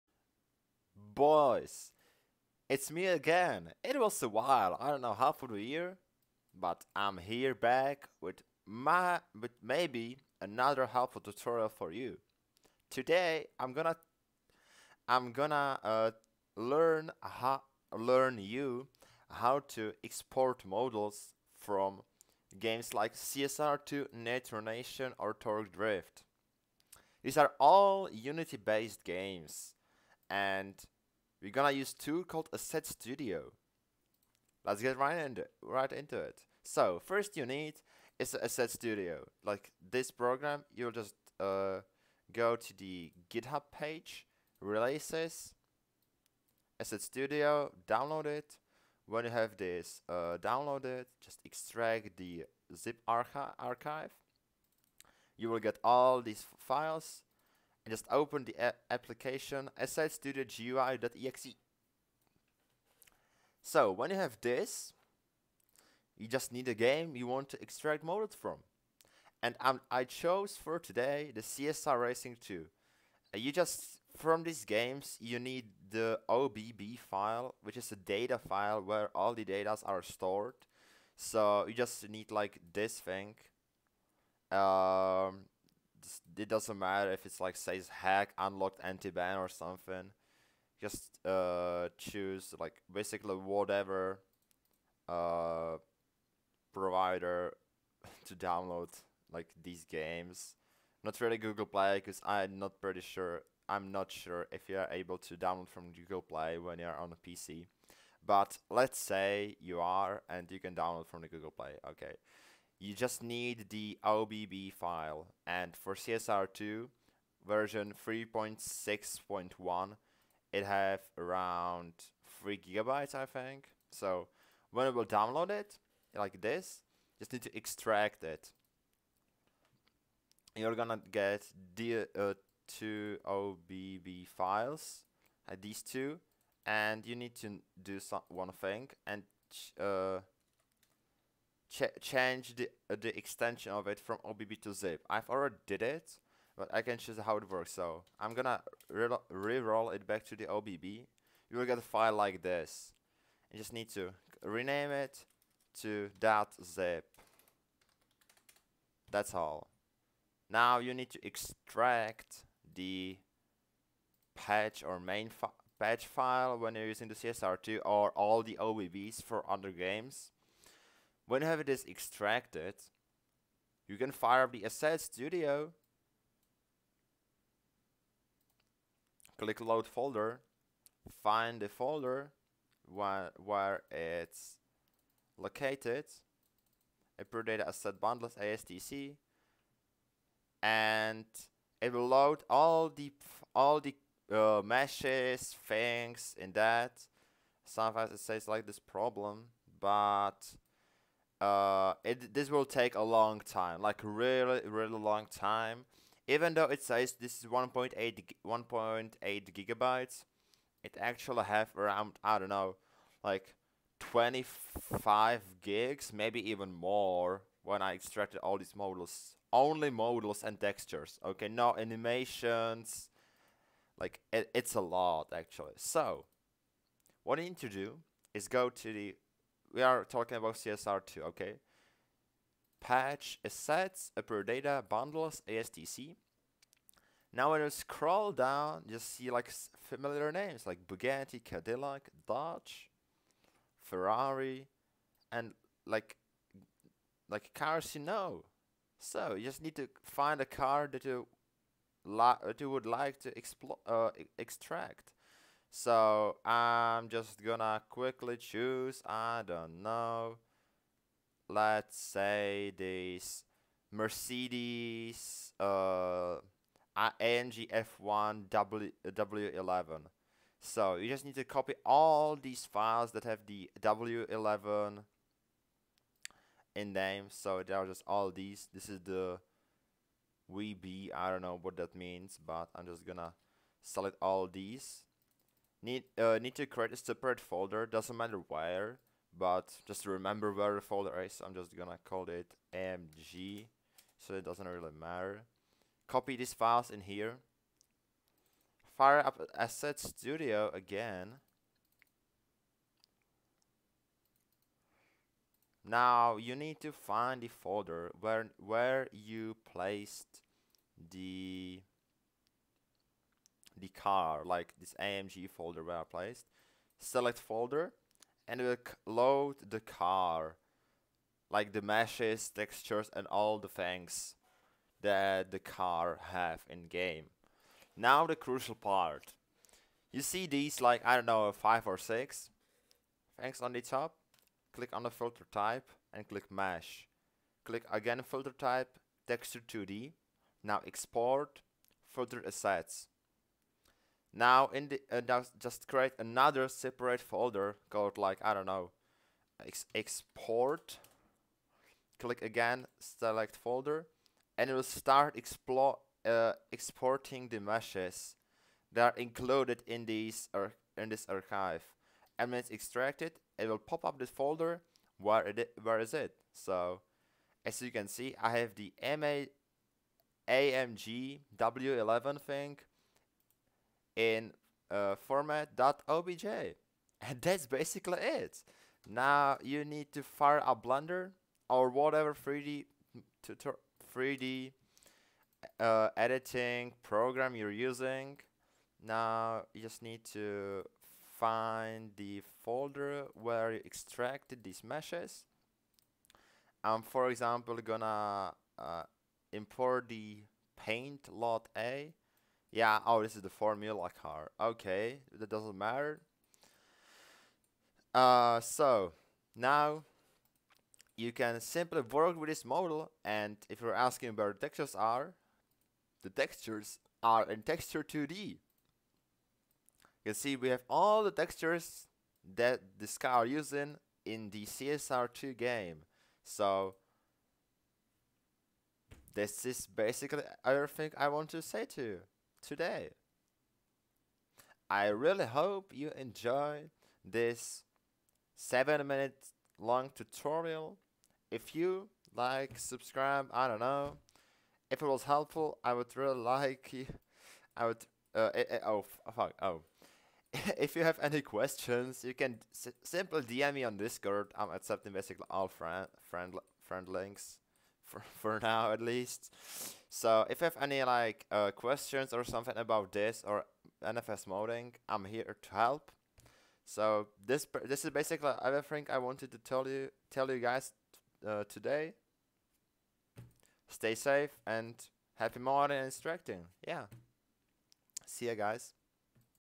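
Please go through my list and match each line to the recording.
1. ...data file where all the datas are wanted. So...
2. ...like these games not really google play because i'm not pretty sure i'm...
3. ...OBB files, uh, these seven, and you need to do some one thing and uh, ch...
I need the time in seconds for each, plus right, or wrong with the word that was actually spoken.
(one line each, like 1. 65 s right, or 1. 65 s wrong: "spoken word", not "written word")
1. 77 s wrong: "stored", not "wanted"
2. 99 s right
3. 133 s wrong: "two", not "seven".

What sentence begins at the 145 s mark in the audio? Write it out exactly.
I've already did it, but I can choose how it works.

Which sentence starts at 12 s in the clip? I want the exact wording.
Today, I'm gonna, I'm gonna uh, learn how, learn you how to export models from games like CSR2, Nation, or Torque Drift.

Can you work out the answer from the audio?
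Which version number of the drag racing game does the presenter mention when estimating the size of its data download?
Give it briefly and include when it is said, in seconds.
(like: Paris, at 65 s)
3.6.1, at 118 s.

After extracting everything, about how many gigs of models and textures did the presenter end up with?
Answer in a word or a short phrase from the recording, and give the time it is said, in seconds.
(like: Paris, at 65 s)
25 gigs, at 213 s.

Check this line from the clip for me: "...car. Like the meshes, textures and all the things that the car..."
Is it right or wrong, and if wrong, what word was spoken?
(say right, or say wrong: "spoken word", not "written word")
right.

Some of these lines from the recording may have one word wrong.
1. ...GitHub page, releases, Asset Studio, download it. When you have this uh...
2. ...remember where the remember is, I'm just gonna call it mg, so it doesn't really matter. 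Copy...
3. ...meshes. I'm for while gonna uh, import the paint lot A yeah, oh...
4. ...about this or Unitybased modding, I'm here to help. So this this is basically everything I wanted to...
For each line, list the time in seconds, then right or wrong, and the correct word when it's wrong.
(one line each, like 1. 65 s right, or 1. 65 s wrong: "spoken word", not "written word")
1. 43 s right
2. 290 s wrong: "folder", not "remember"
3. 394 s wrong: "example", not "while"
4. 462 s wrong: "NFS", not "Unitybased".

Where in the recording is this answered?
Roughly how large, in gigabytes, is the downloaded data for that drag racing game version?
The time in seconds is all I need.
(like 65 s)
122 s.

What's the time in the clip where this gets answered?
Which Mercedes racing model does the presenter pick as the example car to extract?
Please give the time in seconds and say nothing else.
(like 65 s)
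266 s.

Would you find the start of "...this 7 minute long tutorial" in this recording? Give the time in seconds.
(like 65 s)
437 s.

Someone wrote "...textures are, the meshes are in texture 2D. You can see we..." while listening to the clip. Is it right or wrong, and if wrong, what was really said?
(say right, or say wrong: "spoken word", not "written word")
wrong: "textures", not "meshes".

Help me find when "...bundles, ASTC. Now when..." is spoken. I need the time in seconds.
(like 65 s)
234 s.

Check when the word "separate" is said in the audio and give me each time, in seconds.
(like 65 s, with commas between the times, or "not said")
286 s, 346 s.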